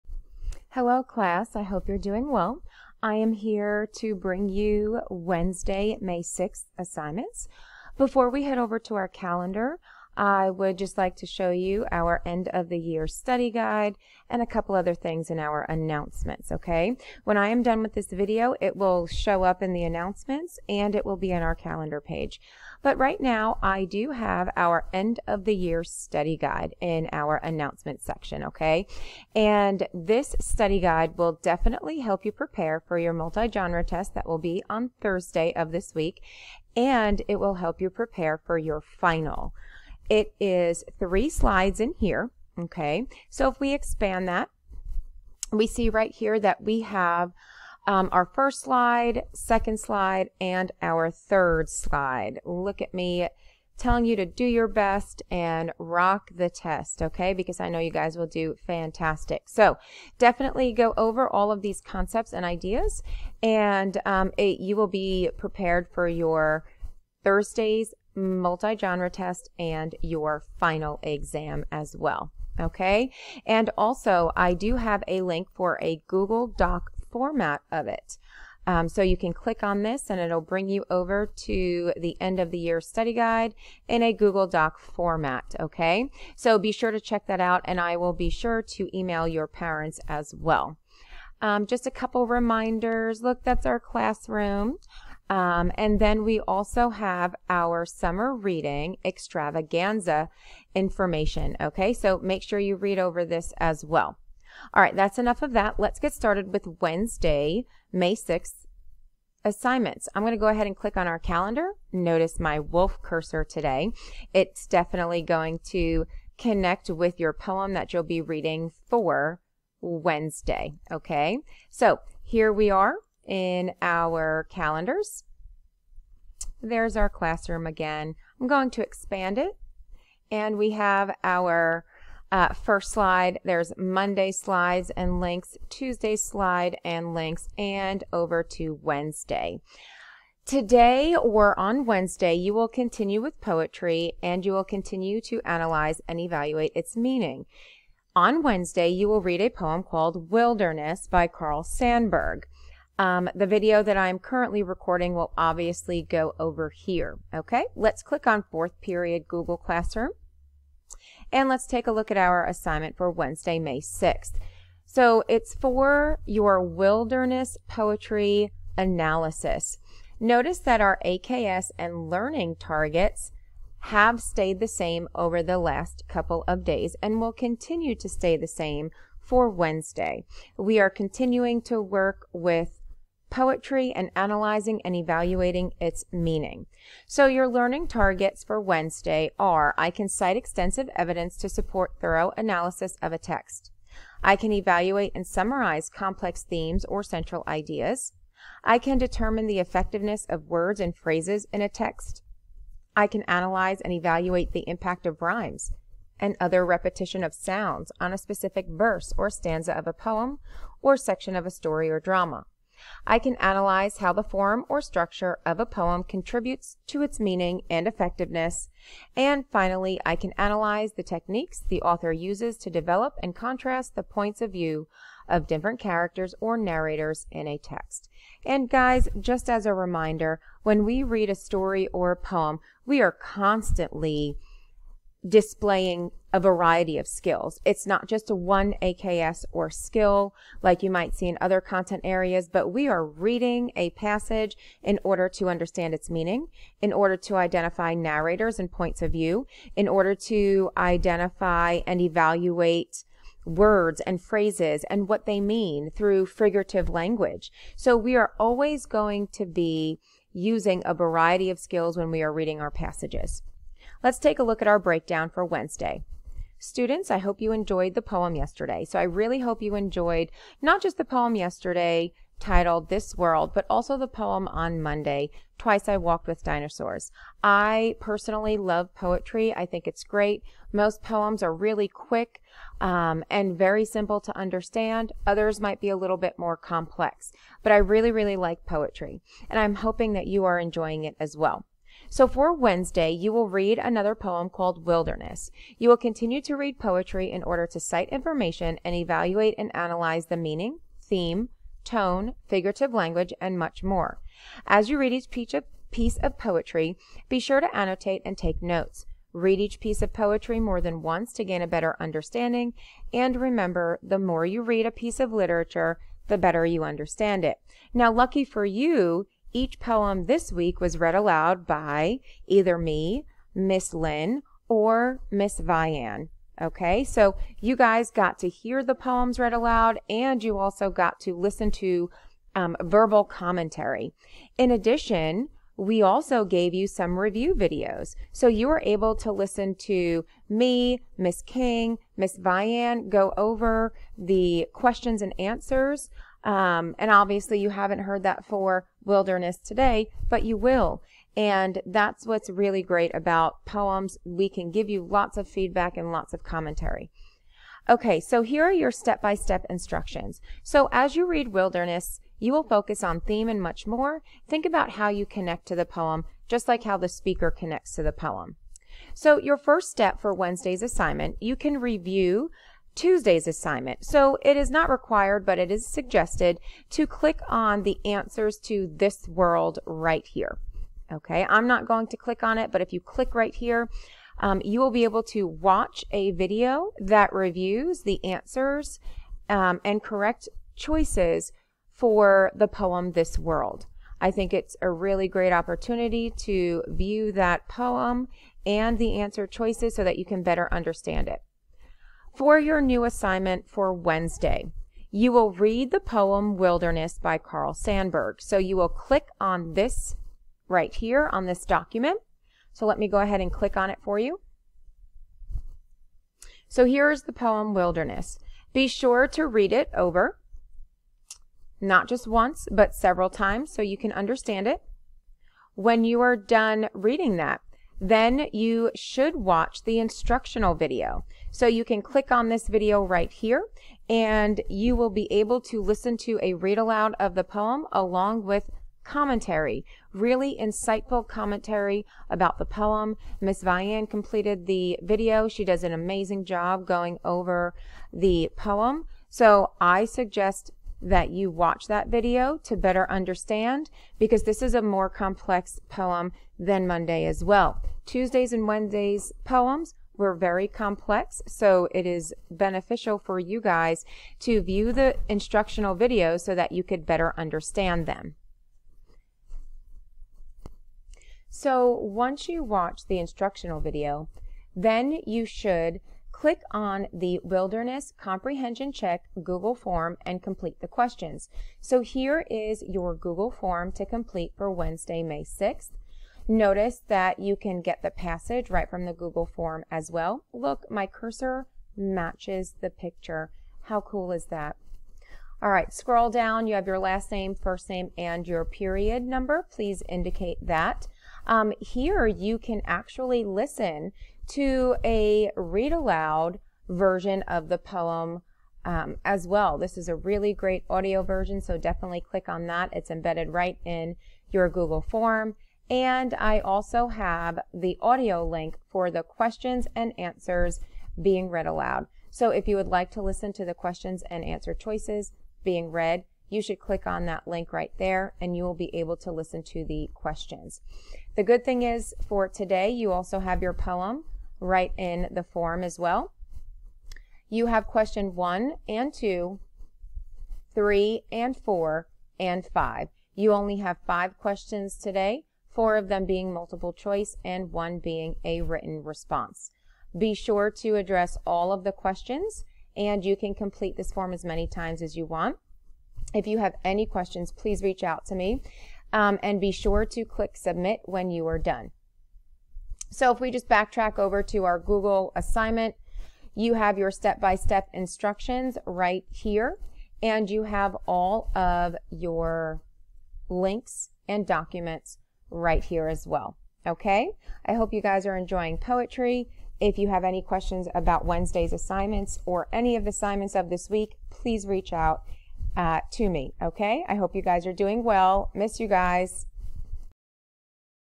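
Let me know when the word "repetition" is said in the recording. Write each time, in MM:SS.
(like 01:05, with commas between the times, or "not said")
03:26.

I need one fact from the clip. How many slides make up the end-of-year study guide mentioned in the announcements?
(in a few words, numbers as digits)
3.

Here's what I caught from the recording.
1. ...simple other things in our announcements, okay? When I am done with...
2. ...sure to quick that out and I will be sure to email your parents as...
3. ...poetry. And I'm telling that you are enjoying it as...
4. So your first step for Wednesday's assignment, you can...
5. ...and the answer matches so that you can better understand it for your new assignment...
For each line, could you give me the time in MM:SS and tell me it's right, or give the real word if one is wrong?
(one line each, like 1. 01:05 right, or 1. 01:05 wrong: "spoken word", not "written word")
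1. 00:14 wrong: "couple", not "simple"
2. 01:26 wrong: "check", not "quick"
3. 04:48 wrong: "hoping", not "telling"
4. 06:09 right
5. 06:38 wrong: "choices", not "matches".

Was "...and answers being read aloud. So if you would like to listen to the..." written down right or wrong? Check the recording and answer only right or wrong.
right.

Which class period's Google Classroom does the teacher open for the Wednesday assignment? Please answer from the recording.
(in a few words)
Fourth period.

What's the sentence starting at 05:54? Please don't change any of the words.
We can give you lots of feedback and lots of commentary.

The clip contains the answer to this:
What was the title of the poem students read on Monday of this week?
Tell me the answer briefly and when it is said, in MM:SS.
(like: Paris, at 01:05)
Twice I Walked with Dinosaurs, at 04:35.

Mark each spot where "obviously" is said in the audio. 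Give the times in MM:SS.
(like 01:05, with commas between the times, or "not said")
02:35, 05:47.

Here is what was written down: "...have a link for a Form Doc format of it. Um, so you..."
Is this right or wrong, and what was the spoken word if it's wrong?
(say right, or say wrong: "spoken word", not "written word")
wrong: "Google", not "Form".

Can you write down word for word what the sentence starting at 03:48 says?
And guys, just as a reminder, when we read a story or a poem, we are constantly displaying a variety of skills.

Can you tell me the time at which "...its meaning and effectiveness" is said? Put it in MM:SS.
03:37.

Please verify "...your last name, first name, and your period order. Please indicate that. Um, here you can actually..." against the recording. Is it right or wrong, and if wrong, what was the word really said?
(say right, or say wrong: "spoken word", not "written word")
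wrong: "number", not "order".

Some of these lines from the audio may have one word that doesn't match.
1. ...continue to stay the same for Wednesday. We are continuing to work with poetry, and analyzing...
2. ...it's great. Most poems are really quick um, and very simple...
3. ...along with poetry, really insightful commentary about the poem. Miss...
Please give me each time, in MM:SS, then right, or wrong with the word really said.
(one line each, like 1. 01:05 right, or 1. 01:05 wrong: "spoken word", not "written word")
1. 02:57 right
2. 04:39 right
3. 07:17 wrong: "commentary", not "poetry".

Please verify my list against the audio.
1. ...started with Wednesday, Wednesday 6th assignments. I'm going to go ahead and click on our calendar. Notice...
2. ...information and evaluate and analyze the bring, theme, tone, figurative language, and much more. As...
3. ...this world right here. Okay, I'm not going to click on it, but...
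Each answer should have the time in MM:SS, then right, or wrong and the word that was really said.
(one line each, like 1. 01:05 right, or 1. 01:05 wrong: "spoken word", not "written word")
1. 01:46 wrong: "May", not "Wednesday"
2. 04:58 wrong: "meaning", not "bring"
3. 06:18 right.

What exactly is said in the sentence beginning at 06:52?
So let me go ahead and click on it for you.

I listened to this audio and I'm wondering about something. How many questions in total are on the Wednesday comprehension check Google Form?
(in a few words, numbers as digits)
5.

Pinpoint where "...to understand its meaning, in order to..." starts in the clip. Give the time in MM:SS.
04:05.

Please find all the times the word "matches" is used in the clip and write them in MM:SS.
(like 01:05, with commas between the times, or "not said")
08:11.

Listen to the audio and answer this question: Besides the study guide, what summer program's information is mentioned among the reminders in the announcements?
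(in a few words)
Summer reading extravaganza.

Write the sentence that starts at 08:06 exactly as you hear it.
Notice that you can get the passage right from the Google form as well.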